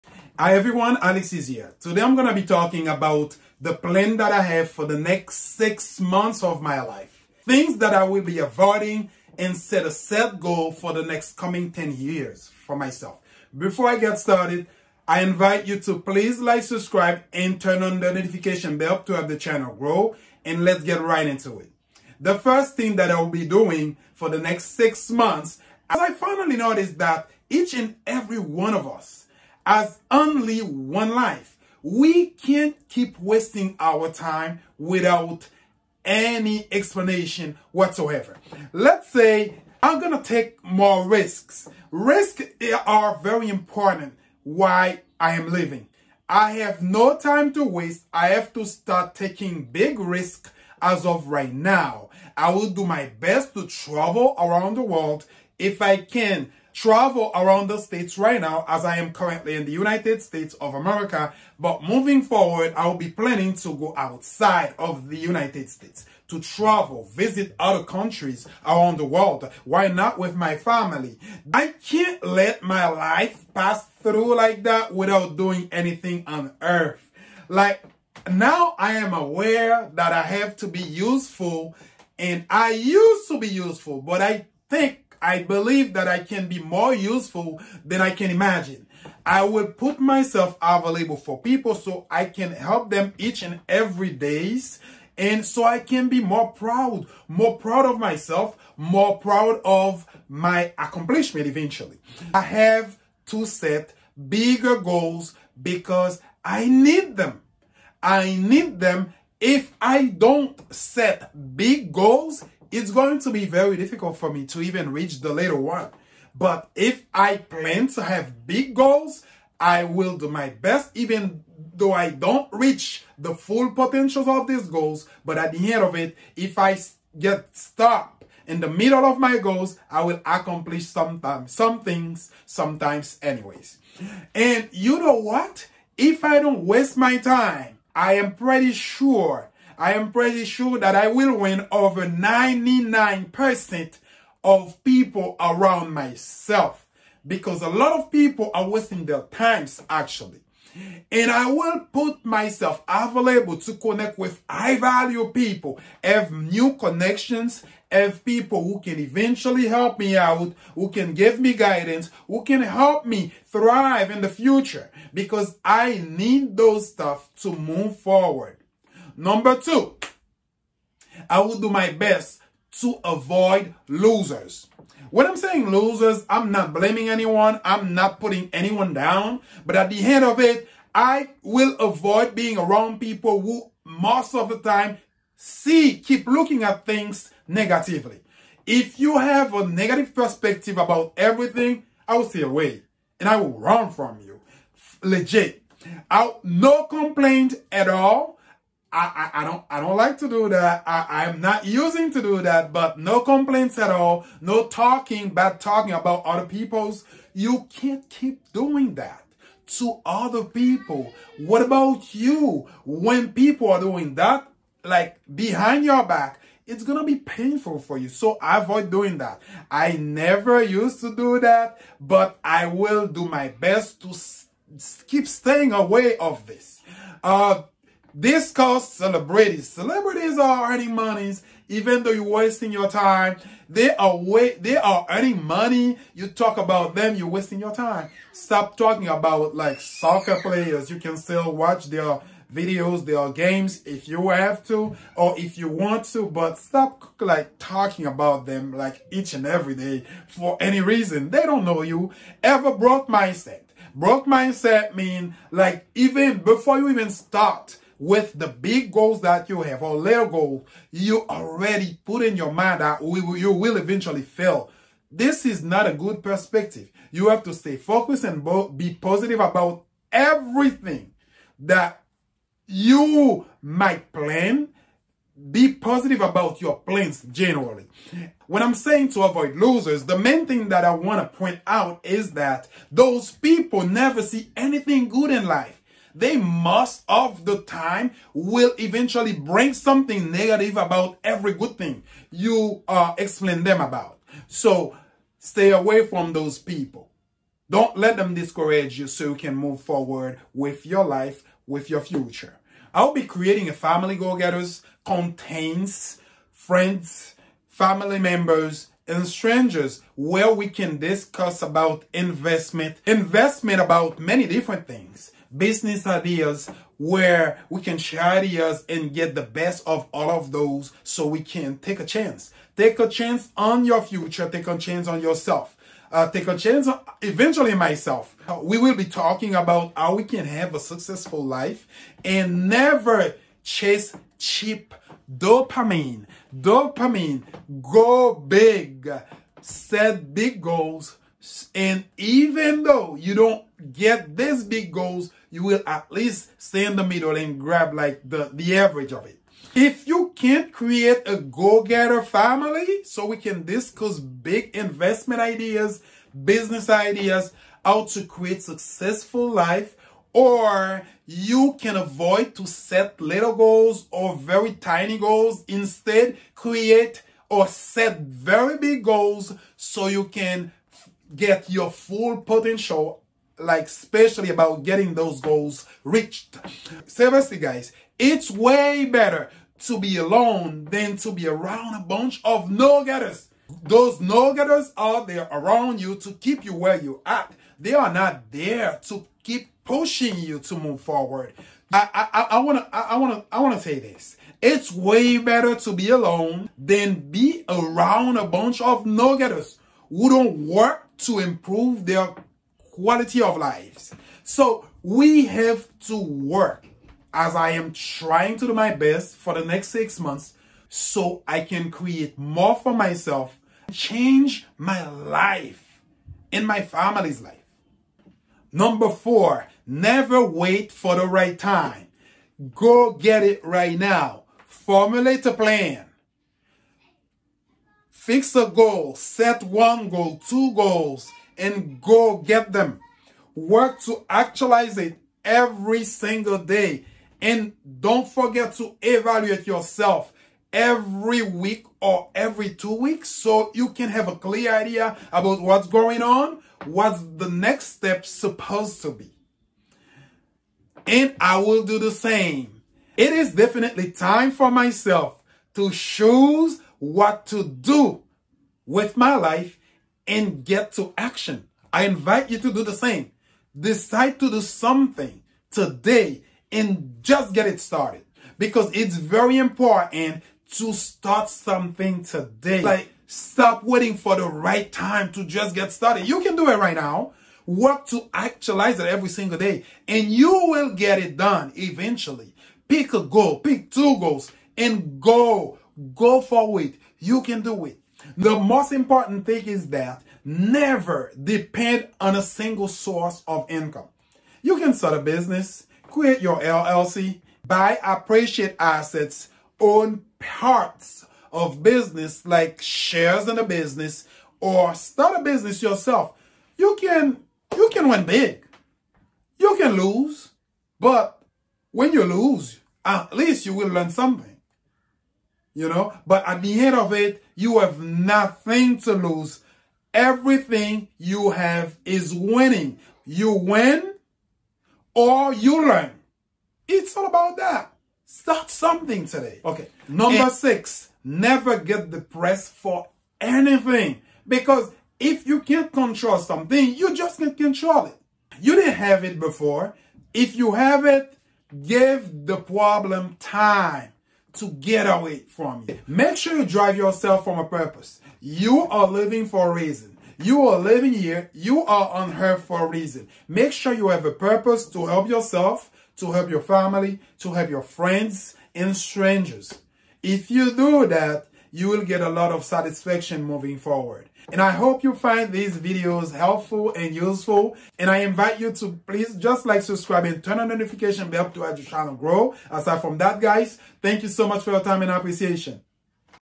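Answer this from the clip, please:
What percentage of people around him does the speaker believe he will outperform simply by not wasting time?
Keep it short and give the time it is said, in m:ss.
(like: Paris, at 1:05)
99%, at 2:22.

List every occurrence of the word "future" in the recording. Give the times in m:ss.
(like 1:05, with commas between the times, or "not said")
2:44, 5:02, 5:24.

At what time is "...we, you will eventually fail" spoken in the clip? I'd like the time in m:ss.
4:23.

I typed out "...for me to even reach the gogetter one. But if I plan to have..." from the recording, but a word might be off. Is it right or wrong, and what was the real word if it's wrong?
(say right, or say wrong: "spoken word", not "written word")
wrong: "later", not "gogetter".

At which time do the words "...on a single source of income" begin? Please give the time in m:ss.
8:12.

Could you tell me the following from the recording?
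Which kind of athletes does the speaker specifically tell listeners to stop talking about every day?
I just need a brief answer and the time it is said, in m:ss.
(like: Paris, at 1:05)
Soccer players, at 3:59.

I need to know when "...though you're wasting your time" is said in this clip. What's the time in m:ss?
3:52.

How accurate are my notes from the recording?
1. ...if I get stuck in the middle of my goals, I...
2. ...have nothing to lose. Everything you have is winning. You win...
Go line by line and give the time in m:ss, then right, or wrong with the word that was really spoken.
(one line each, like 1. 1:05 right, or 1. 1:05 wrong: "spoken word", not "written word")
1. 2:06 right
2. 8:37 right.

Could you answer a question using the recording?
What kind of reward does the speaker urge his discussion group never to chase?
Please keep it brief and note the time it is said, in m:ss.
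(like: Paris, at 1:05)
Cheap dopamine, at 5:34.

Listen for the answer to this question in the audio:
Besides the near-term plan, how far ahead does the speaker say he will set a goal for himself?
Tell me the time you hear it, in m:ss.
0:11.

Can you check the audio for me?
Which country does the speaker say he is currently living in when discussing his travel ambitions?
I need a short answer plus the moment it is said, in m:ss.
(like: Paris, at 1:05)
United States of America, at 0:59.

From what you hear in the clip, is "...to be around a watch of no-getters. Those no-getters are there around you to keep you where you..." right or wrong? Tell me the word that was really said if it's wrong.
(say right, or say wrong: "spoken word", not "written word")
wrong: "bunch", not "watch".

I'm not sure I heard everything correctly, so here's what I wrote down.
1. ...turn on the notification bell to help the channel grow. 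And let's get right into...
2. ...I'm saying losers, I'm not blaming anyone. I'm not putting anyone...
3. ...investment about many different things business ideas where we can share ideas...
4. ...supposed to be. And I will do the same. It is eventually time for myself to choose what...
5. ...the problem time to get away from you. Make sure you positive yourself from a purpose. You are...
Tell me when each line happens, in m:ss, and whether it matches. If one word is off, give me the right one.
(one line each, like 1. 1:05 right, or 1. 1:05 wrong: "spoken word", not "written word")
1. 0:17 right
2. 2:55 right
3. 5:13 right
4. 7:28 wrong: "definitely", not "eventually"
5. 9:02 wrong: "drive", not "positive".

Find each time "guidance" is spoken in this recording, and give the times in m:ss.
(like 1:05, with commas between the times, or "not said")
2:41.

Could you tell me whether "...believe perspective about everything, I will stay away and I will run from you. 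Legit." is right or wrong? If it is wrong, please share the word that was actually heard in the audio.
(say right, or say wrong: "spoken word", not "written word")
wrong: "negative", not "believe".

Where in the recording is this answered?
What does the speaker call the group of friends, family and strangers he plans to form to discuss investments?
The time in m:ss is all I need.
5:03.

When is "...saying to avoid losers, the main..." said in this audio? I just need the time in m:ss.
4:38.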